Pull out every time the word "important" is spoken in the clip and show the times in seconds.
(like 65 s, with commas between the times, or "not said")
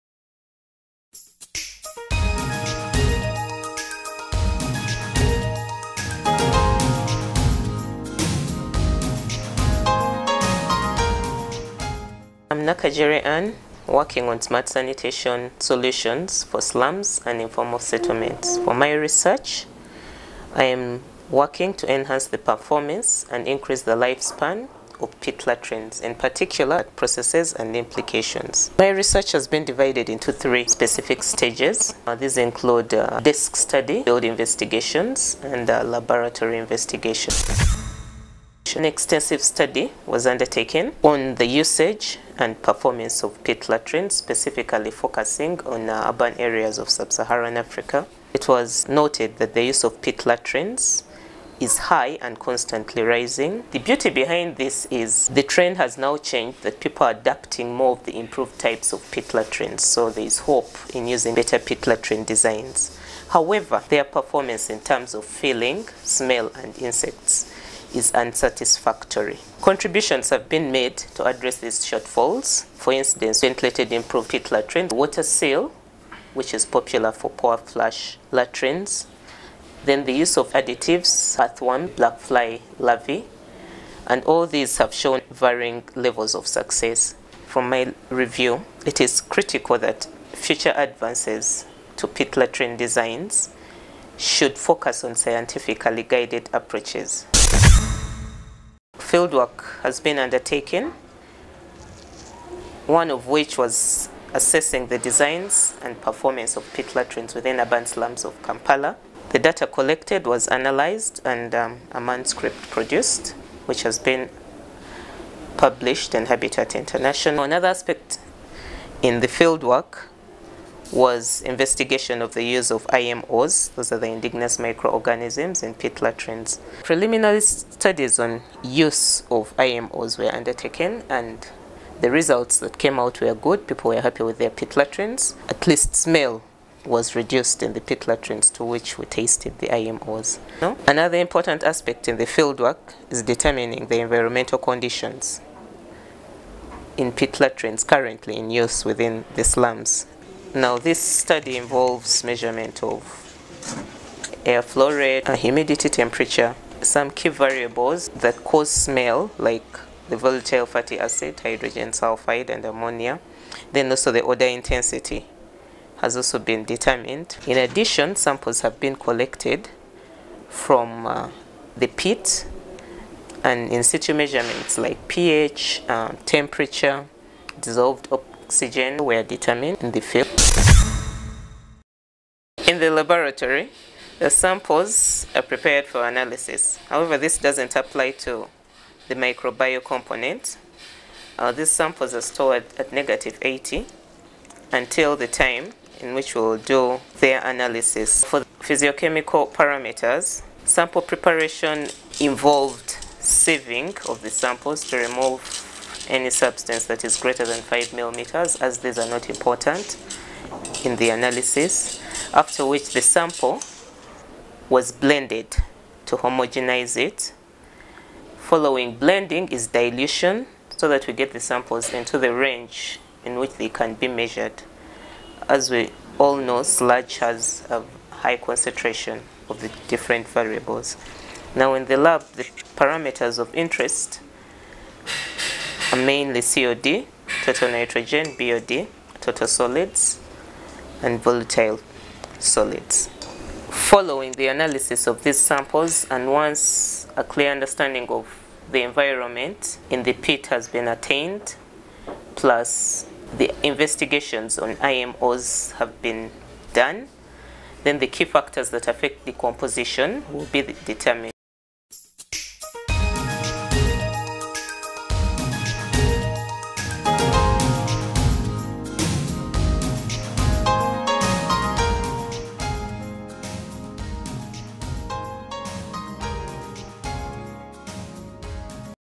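141 s, 209 s.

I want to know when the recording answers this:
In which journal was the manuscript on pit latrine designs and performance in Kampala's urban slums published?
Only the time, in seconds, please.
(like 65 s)
116 s.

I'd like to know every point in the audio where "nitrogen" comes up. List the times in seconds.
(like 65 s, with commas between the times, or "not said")
237 s.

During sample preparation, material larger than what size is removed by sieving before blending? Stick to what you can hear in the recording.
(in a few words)
5 millimeters.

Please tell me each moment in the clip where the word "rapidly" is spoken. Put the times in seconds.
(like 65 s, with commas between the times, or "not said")
not said.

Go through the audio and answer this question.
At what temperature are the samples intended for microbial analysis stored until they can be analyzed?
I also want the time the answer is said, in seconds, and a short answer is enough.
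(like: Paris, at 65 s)
-80, at 192 s.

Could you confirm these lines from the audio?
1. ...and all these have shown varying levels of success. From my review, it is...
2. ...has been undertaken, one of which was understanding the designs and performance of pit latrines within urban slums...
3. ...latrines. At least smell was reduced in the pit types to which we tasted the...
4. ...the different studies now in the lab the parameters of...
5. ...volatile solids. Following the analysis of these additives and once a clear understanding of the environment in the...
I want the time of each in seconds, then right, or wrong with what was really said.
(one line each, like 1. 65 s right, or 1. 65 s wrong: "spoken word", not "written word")
1. 84 s right
2. 99 s wrong: "assessing", not "understanding"
3. 134 s wrong: "latrines", not "types"
4. 229 s wrong: "variables", not "studies"
5. 241 s wrong: "samples", not "additives".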